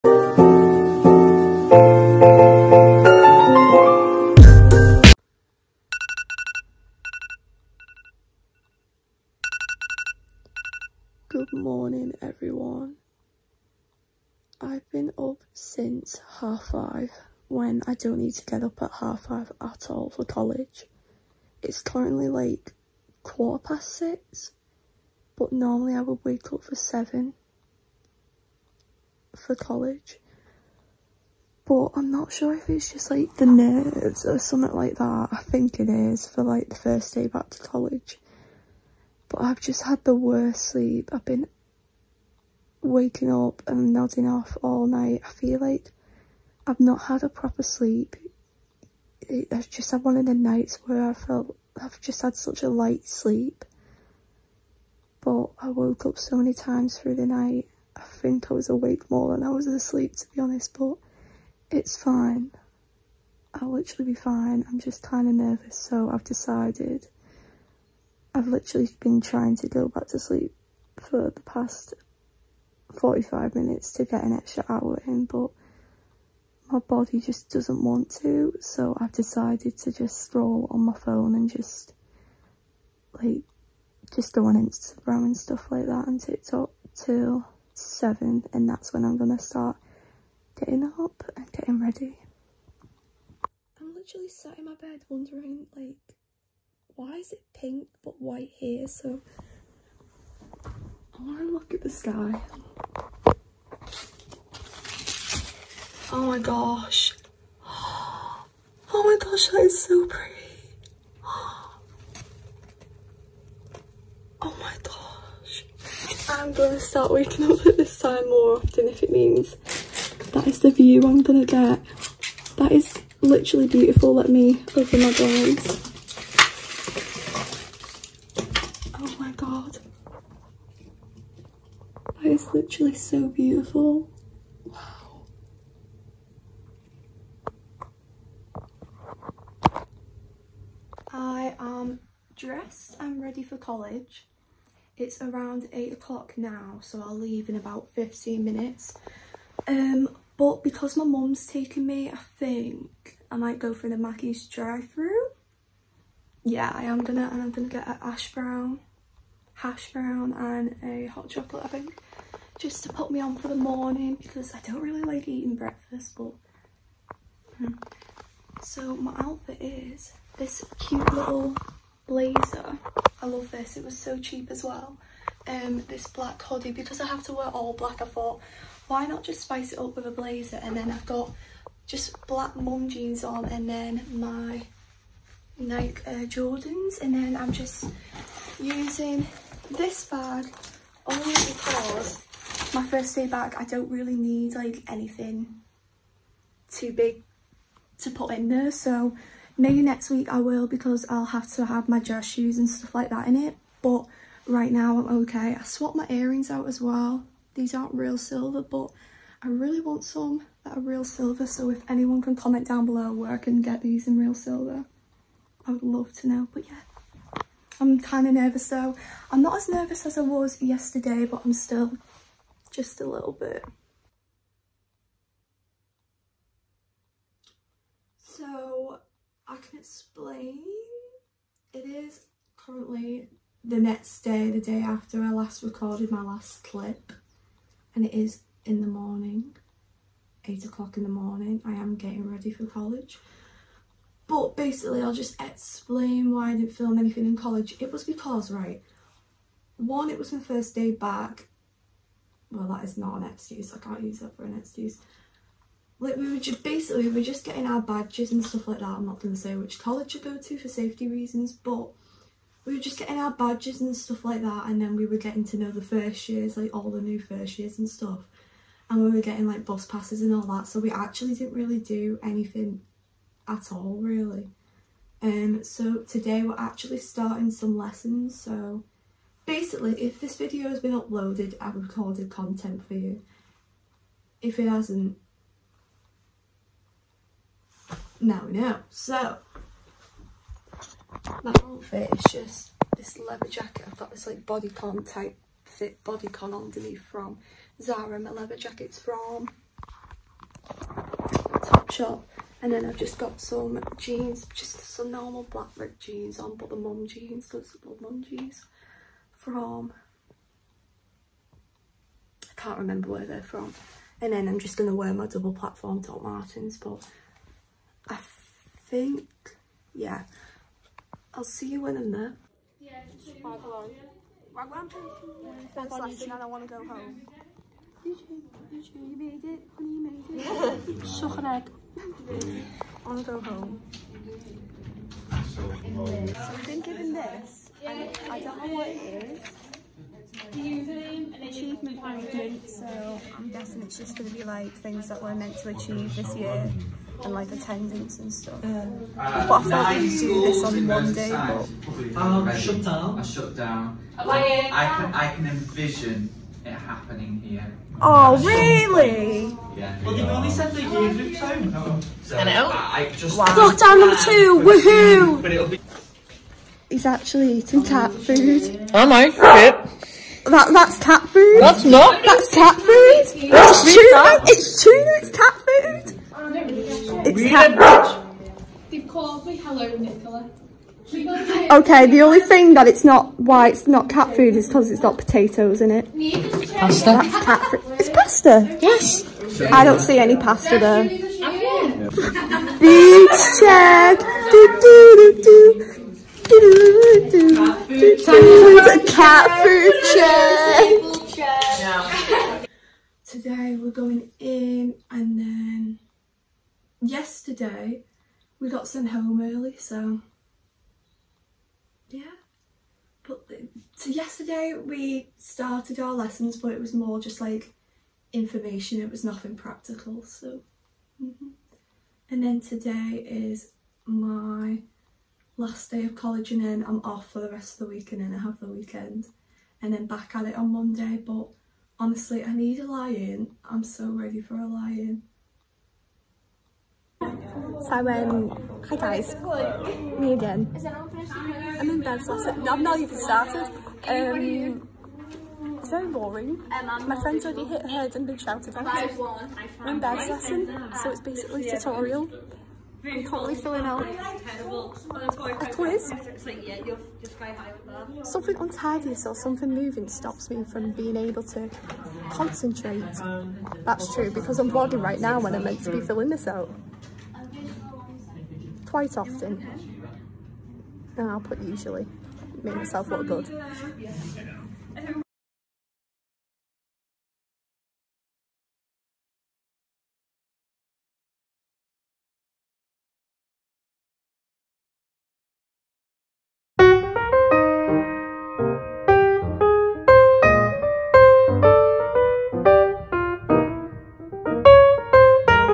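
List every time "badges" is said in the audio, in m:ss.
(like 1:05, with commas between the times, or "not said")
4:17, 4:23.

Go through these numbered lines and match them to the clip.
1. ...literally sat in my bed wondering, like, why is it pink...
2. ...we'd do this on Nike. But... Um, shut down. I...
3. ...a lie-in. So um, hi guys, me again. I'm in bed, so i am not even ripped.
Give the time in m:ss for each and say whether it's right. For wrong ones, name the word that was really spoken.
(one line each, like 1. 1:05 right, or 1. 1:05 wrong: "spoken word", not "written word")
1. 1:33 right
2. 5:49 wrong: "Monday", not "Nike"
3. 7:14 wrong: "started", not "ripped".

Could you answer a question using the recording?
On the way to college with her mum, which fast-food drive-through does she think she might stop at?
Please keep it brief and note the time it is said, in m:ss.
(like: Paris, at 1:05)
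Mackie's, at 2:33.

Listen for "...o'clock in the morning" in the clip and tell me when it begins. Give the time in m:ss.
4:00.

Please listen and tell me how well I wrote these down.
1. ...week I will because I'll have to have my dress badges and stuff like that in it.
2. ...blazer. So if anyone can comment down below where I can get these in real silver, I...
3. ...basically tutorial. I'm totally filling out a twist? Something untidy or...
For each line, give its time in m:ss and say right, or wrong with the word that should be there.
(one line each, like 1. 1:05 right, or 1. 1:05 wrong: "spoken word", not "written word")
1. 3:20 wrong: "shoes", not "badges"
2. 3:31 wrong: "silver", not "blazer"
3. 7:31 right.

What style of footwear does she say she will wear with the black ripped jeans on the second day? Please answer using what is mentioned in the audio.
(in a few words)
double platform Doc Martens.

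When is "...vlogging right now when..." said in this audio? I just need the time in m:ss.
7:44.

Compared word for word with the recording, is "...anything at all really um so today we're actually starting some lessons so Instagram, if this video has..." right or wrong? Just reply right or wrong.
wrong.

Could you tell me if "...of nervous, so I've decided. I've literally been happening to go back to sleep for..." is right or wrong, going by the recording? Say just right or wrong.
wrong.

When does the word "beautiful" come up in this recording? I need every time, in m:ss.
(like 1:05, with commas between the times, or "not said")
2:03, 2:13.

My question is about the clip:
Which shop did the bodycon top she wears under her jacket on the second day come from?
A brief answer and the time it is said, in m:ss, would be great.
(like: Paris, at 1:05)
Zara, at 4:57.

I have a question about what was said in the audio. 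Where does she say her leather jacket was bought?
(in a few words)
Topshop.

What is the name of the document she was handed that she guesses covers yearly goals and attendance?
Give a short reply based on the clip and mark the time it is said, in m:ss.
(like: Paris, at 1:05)
Achievement management, at 5:40.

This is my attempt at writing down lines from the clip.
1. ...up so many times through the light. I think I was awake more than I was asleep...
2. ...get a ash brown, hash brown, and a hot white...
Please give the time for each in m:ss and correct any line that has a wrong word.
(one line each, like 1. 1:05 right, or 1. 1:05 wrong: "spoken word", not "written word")
1. 0:56 wrong: "night", not "light"
2. 2:37 wrong: "chocolate", not "white".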